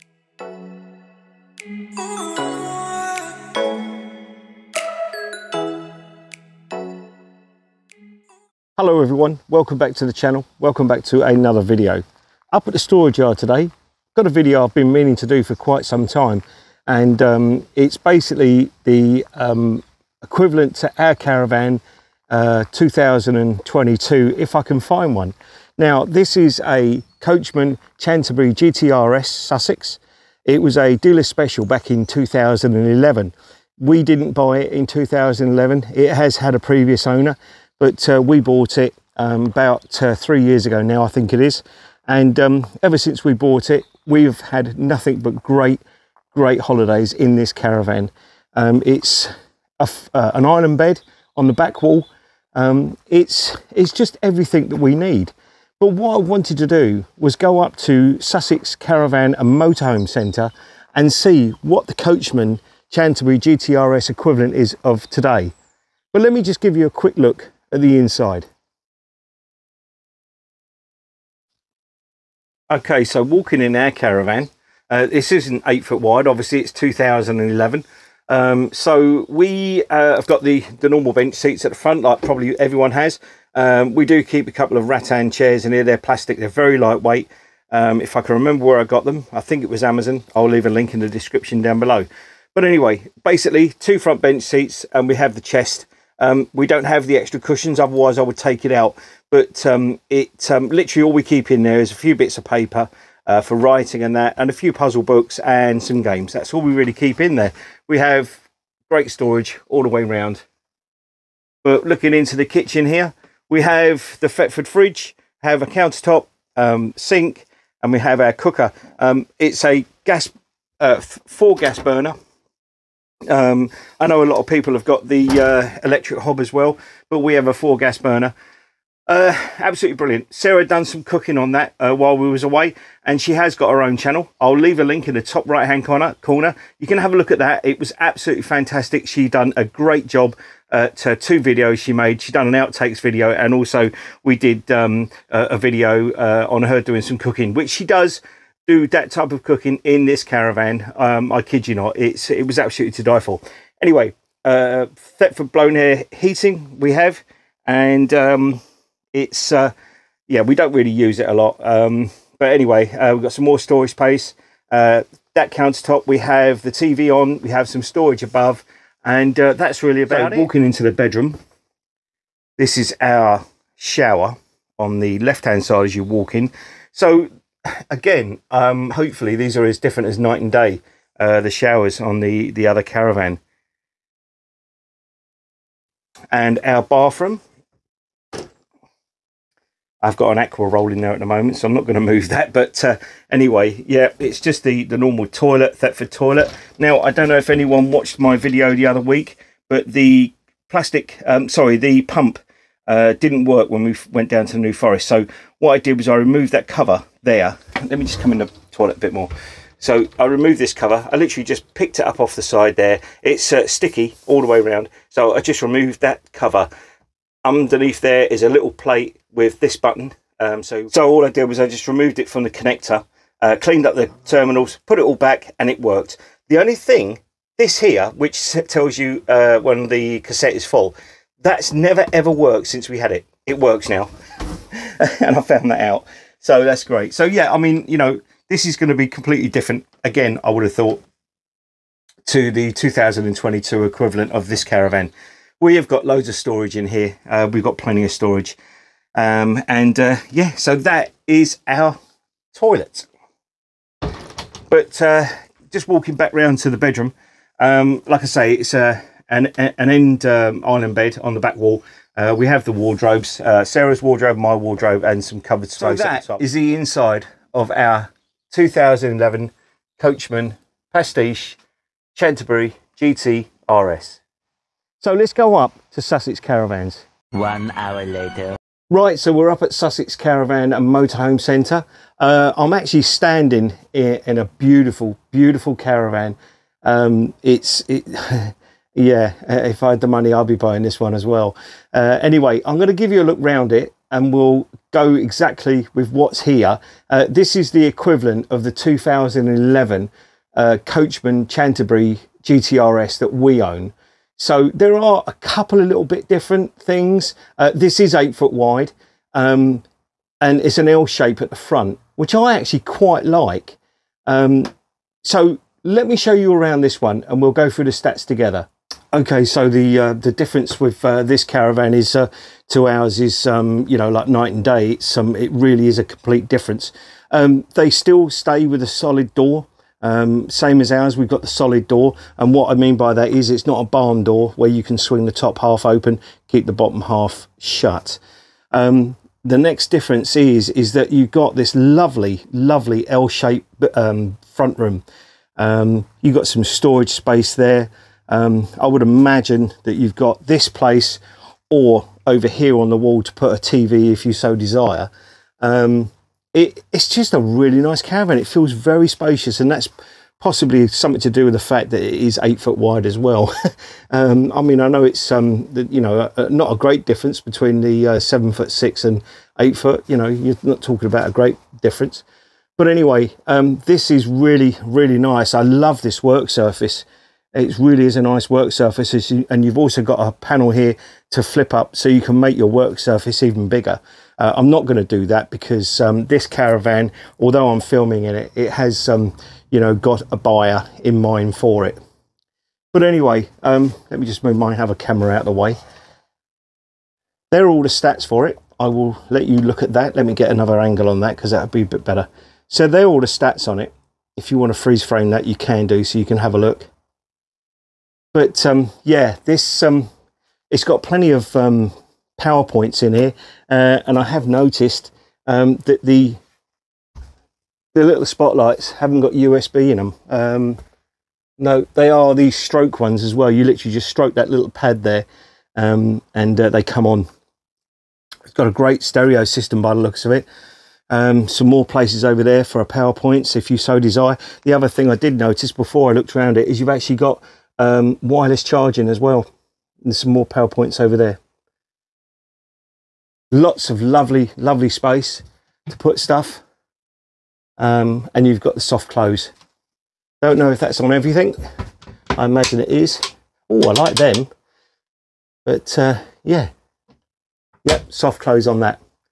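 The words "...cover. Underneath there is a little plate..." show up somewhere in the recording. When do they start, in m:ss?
3:36.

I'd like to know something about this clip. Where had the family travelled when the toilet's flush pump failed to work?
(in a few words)
New Forest.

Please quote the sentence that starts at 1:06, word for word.
But let me just give you a quick look at the inside.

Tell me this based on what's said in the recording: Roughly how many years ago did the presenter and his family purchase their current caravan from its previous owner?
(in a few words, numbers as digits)
3 years.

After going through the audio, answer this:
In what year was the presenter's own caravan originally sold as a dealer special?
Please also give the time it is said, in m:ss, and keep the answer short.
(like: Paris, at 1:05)
2011, at 0:30.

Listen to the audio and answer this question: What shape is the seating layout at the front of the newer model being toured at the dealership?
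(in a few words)
L shape.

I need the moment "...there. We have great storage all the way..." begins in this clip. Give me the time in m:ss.
1:47.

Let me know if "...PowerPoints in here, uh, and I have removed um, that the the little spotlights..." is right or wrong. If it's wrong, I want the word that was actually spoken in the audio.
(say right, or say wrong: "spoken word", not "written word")
wrong: "noticed", not "removed".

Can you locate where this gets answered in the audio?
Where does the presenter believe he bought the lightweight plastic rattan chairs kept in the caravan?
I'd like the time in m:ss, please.
1:29.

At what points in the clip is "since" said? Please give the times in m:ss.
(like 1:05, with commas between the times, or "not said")
0:42, 3:52.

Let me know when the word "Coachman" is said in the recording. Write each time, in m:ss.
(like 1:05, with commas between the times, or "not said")
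0:27, 1:01, 4:29, 5:00.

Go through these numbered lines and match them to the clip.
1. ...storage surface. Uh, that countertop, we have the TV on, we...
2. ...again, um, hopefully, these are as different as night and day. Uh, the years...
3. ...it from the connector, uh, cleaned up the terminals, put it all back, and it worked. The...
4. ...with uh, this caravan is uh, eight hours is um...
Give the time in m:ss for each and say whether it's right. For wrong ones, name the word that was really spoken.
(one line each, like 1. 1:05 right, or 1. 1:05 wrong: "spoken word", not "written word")
1. 2:43 wrong: "space", not "surface"
2. 2:57 wrong: "showers", not "years"
3. 3:42 right
4. 5:20 wrong: "two", not "eight".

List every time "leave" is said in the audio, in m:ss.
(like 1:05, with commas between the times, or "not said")
1:30, 2:14.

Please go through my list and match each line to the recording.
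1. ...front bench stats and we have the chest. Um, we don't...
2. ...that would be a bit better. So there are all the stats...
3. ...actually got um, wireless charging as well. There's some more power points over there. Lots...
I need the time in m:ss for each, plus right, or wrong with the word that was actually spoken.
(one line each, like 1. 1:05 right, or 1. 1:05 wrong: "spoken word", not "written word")
1. 1:33 wrong: "seats", not "stats"
2. 6:41 right
3. 7:16 right.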